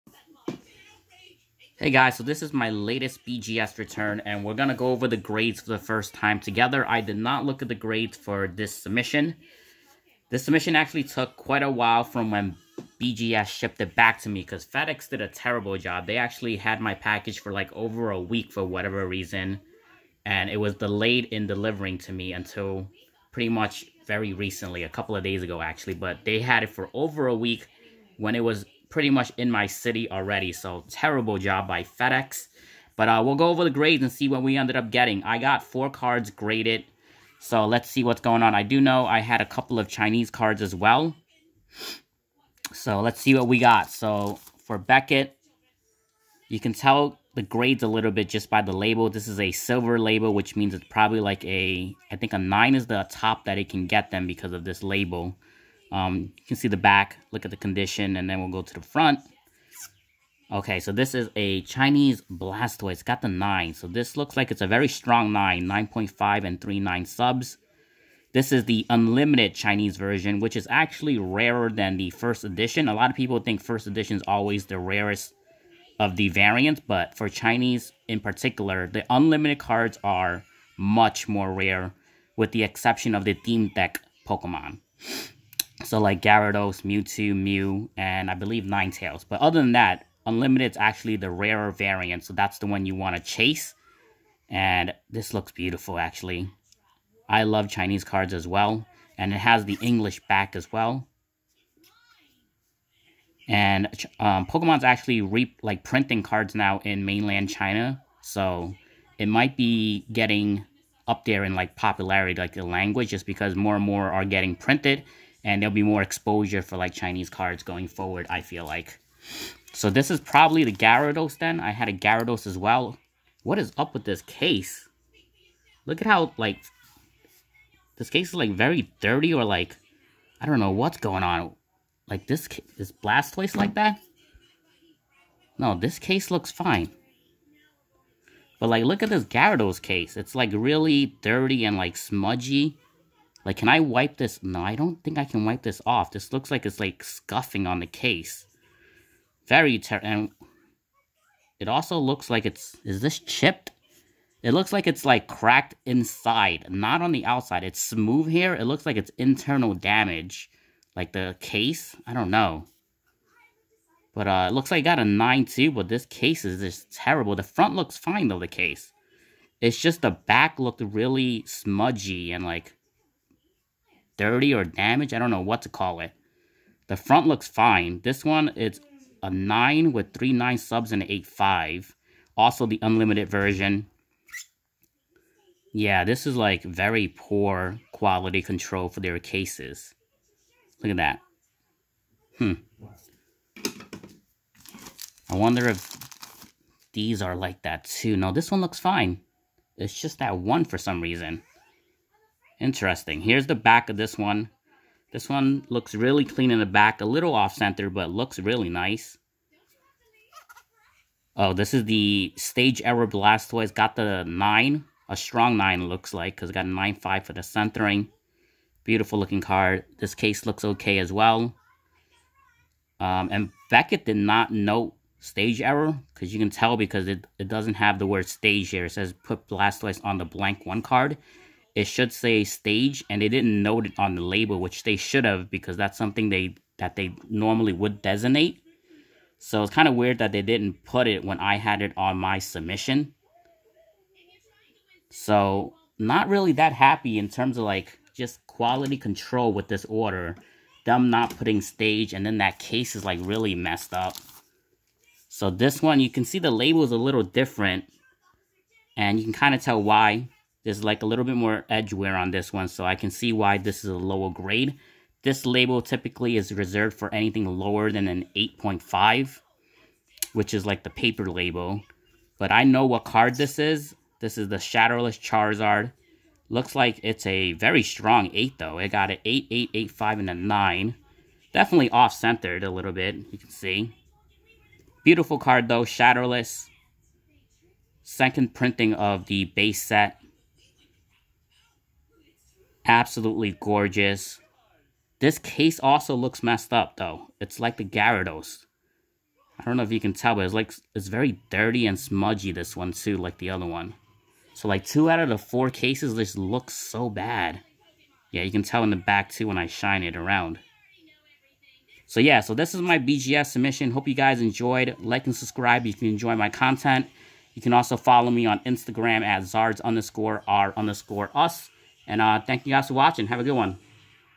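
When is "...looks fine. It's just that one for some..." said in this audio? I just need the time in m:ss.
3:18.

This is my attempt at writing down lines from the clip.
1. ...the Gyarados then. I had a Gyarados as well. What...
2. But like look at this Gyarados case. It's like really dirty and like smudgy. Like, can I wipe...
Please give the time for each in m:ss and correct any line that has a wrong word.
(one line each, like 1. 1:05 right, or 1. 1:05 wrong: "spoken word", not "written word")
1. 2:00 right
2. 2:18 right.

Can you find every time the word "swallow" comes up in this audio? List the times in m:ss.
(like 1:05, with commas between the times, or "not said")
not said.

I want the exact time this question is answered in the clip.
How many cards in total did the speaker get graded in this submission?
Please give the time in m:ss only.
0:35.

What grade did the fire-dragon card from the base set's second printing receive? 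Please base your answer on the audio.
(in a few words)
8.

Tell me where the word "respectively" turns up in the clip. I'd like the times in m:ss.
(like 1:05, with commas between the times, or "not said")
not said.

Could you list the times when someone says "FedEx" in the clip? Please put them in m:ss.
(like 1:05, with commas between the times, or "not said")
0:14, 0:31.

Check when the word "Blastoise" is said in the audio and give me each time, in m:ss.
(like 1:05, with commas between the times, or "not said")
1:02, 2:12, 3:33, 3:49.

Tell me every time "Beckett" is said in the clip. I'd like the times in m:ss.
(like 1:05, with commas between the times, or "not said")
0:44, 3:43.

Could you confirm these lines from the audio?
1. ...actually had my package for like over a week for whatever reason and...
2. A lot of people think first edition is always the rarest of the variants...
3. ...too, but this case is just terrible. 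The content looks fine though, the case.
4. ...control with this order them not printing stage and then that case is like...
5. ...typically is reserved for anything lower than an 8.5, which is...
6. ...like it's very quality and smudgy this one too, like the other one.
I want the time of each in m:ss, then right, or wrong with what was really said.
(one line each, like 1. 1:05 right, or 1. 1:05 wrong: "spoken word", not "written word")
1. 0:16 right
2. 1:12 right
3. 2:45 wrong: "front", not "content"
4. 4:08 wrong: "putting", not "printing"
5. 4:25 right
6. 5:00 wrong: "dirty", not "quality".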